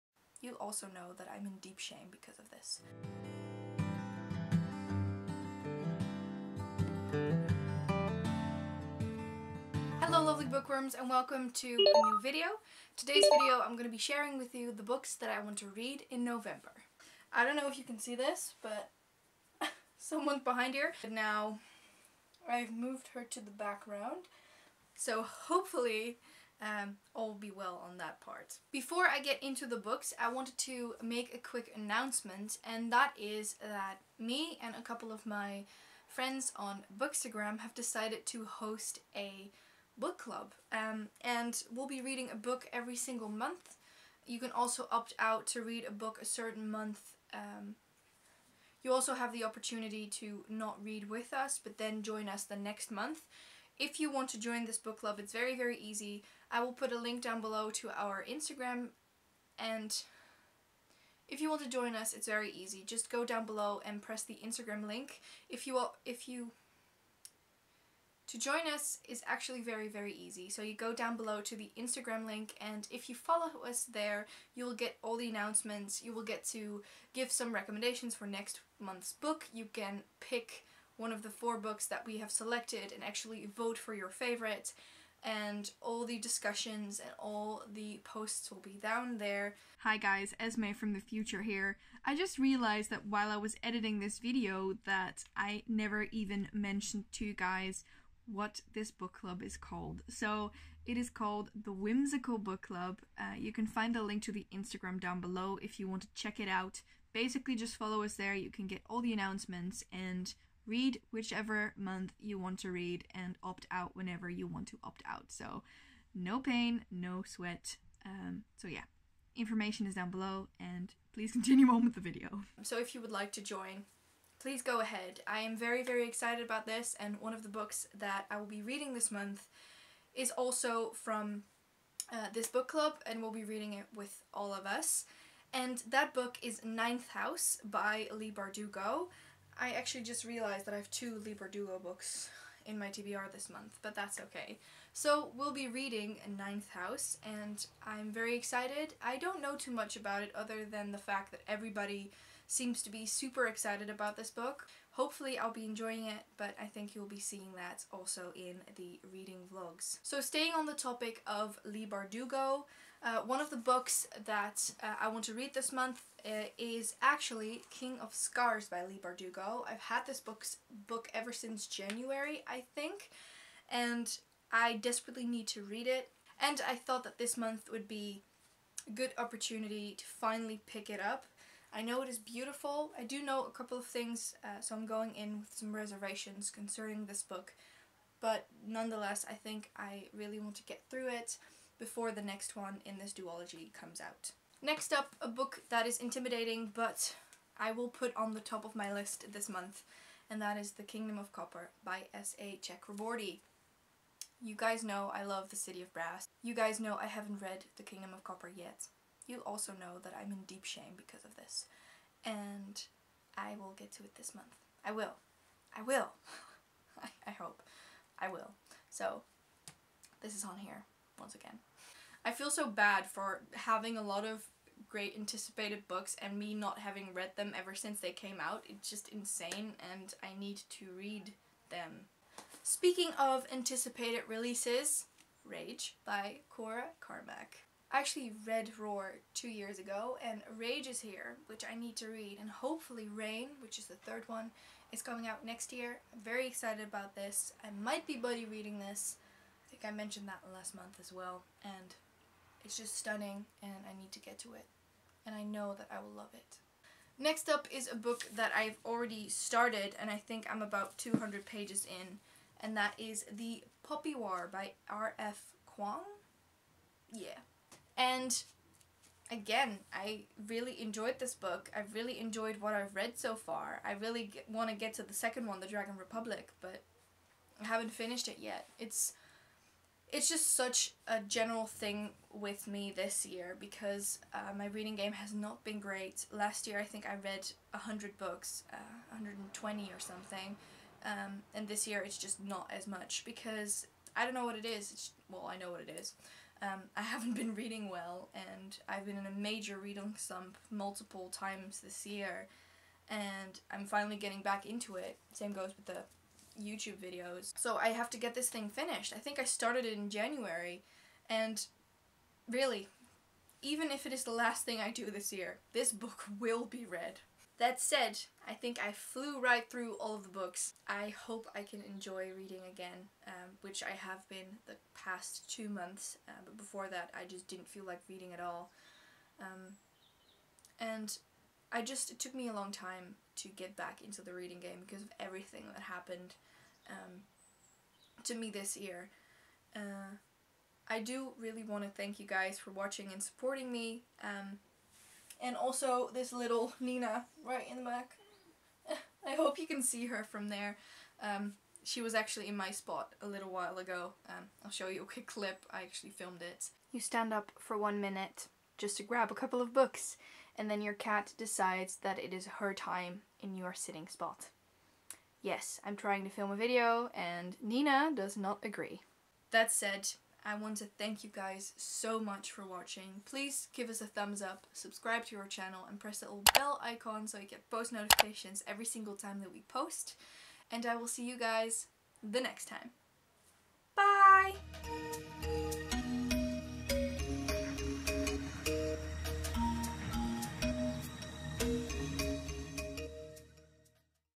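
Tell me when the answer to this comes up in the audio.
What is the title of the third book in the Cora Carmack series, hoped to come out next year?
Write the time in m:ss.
4:03.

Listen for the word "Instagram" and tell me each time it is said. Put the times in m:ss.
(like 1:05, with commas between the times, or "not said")
0:58, 1:04, 1:11, 1:44.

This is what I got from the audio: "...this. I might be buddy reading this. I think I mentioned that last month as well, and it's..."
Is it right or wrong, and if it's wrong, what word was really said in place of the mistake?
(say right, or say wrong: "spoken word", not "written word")
right.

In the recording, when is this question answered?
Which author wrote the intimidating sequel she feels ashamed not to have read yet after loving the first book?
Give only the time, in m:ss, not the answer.
3:22.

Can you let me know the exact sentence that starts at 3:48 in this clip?
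It's just insane and I need to read them.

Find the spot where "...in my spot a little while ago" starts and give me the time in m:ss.
5:52.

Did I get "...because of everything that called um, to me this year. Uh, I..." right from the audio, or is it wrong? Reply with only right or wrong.
wrong.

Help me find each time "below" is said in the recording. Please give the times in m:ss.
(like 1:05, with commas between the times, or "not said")
0:57, 1:03, 1:11, 1:45, 2:00.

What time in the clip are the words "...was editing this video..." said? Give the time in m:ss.
1:33.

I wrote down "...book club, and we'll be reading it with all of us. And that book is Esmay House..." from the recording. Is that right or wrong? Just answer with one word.
wrong.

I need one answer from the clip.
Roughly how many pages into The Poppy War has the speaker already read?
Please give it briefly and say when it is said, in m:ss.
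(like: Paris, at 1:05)
200, at 4:20.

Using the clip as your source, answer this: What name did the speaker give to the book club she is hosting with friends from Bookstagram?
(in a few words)
The Whimsical Book Club.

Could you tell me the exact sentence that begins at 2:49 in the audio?
I've had this book's book ever since January, I think, and I desperately need to read it.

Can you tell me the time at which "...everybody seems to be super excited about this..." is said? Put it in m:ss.
2:31.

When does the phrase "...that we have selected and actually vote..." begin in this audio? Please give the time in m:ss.
1:21.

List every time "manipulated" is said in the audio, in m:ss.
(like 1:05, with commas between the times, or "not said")
not said.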